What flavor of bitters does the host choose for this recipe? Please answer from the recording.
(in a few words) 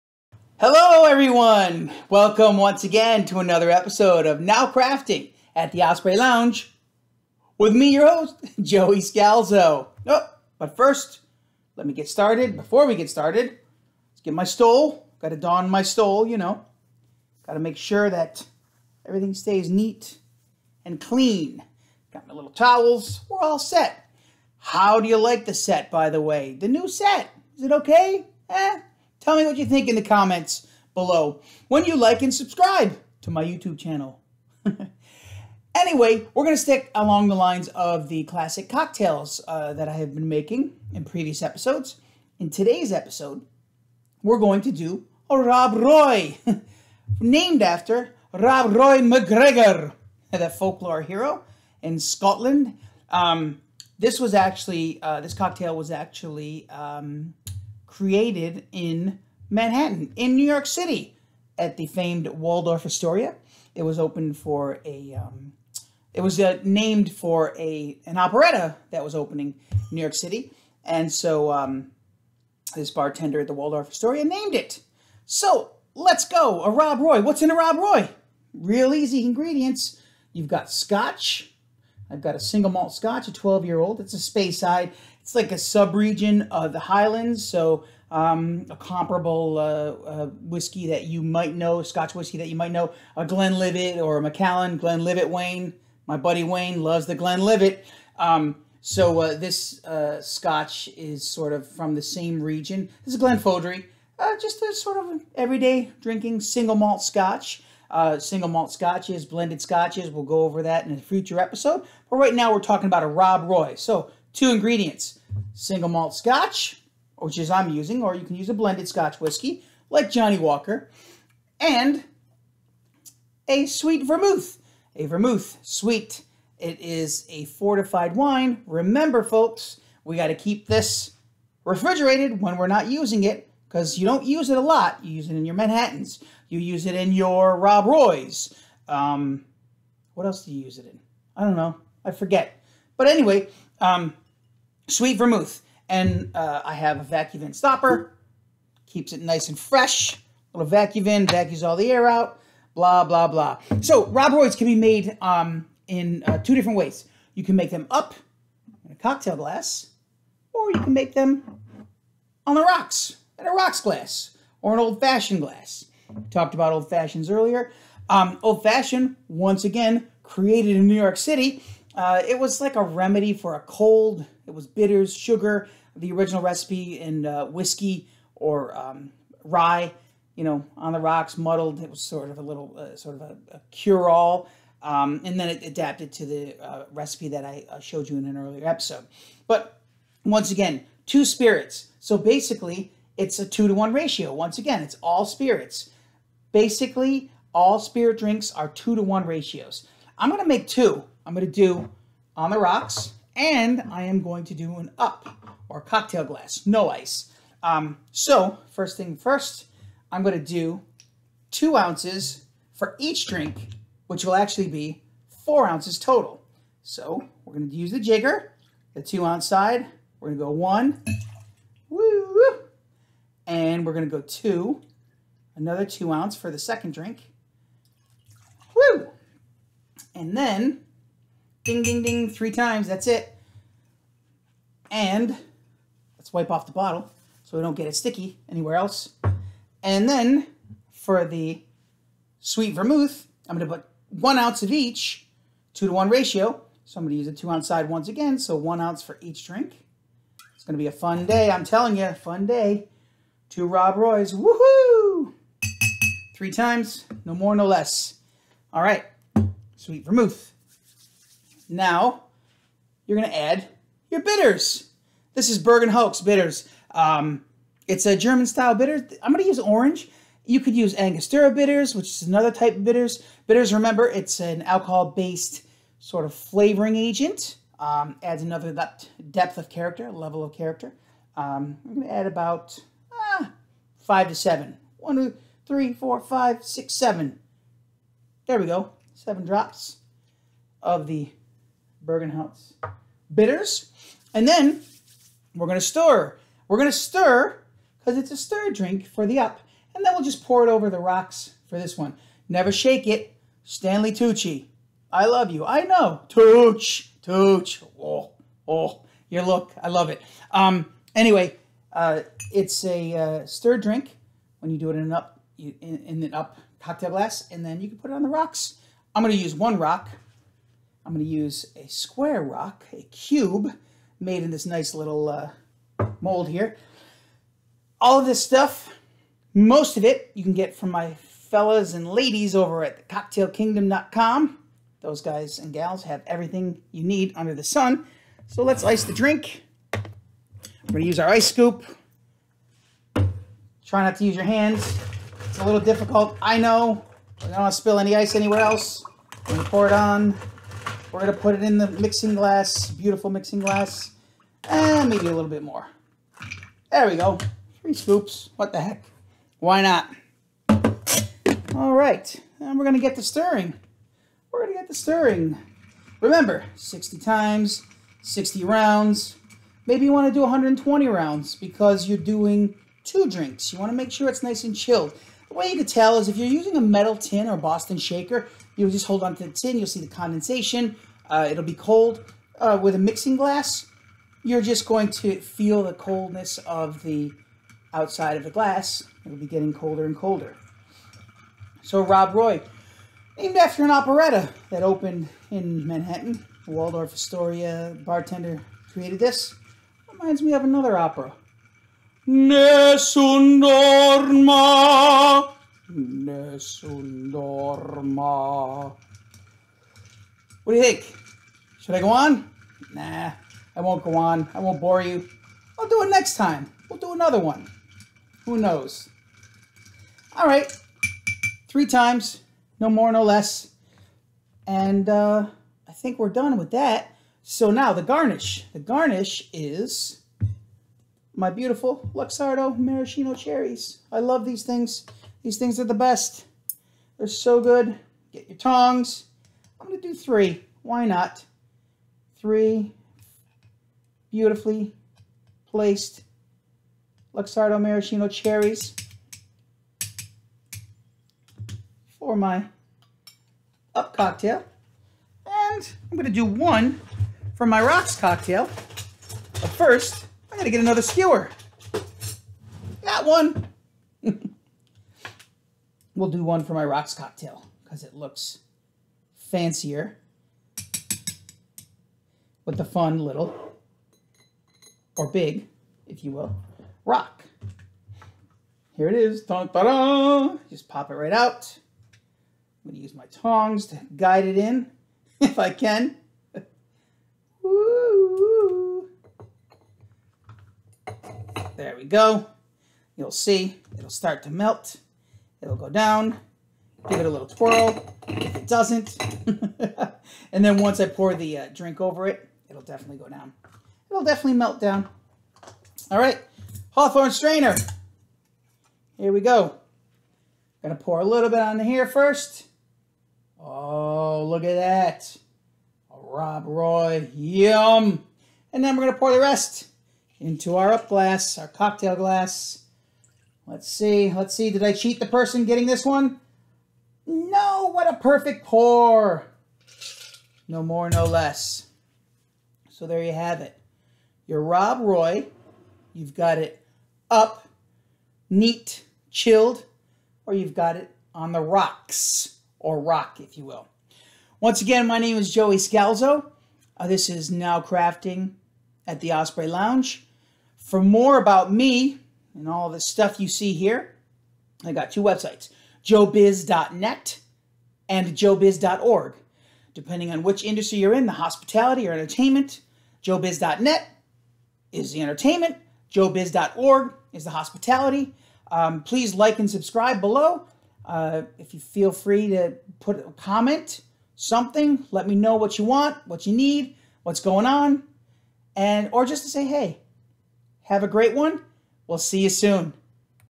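Orange.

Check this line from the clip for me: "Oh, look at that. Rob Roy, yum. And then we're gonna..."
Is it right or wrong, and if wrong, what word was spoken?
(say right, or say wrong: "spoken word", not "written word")
right.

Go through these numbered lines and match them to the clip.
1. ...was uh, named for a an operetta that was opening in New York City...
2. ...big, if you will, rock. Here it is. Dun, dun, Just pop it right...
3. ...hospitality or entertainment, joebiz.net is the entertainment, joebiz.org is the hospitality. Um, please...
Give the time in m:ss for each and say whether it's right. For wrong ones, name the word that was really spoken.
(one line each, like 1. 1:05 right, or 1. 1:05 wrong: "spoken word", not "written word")
1. 1:06 right
2. 7:55 right
3. 9:21 right.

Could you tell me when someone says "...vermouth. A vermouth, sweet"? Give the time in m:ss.
2:04.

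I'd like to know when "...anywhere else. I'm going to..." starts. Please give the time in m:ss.
5:48.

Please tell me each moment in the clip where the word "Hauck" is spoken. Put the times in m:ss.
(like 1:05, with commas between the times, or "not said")
4:25, 4:52.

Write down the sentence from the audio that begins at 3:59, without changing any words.
And then for the sweet vermouth, I'm going to put one ounce of each, two to one ratio.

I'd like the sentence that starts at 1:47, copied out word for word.
Uh, single malt scotches, blended scotches.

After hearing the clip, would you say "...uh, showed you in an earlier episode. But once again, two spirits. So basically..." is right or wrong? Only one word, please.
right.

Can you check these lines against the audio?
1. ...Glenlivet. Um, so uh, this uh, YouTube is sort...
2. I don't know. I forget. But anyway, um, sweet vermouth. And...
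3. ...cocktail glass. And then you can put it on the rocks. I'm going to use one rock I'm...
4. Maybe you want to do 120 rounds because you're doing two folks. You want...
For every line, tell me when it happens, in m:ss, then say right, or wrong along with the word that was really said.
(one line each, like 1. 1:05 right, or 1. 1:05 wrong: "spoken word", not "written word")
1. 1:37 wrong: "Scotch", not "YouTube"
2. 2:21 right
3. 5:16 right
4. 6:09 wrong: "drinks", not "folks".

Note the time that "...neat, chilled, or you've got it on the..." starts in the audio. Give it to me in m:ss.
8:58.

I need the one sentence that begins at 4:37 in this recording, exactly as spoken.
Um, adds another depth of character, level of character.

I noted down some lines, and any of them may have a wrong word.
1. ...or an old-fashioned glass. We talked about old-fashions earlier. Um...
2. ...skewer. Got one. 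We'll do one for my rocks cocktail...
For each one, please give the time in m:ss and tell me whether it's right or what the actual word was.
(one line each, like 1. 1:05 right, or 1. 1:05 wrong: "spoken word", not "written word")
1. 2:44 right
2. 7:41 right.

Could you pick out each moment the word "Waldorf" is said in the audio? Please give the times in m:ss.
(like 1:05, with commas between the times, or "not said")
1:02, 1:13, 6:36.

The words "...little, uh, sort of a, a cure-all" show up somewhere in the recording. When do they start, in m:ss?
3:02.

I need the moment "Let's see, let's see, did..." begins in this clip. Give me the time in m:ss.
8:43.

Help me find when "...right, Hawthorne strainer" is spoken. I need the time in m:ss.
8:26.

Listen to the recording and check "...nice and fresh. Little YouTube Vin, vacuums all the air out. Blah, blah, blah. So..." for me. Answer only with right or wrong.
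wrong.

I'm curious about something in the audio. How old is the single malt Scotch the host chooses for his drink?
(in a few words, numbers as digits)
12 year old.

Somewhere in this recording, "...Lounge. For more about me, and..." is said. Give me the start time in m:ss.
9:09.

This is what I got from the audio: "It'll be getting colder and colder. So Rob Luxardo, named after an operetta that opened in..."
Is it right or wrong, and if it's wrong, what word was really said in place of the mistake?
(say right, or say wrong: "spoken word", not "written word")
wrong: "Roy", not "Luxardo".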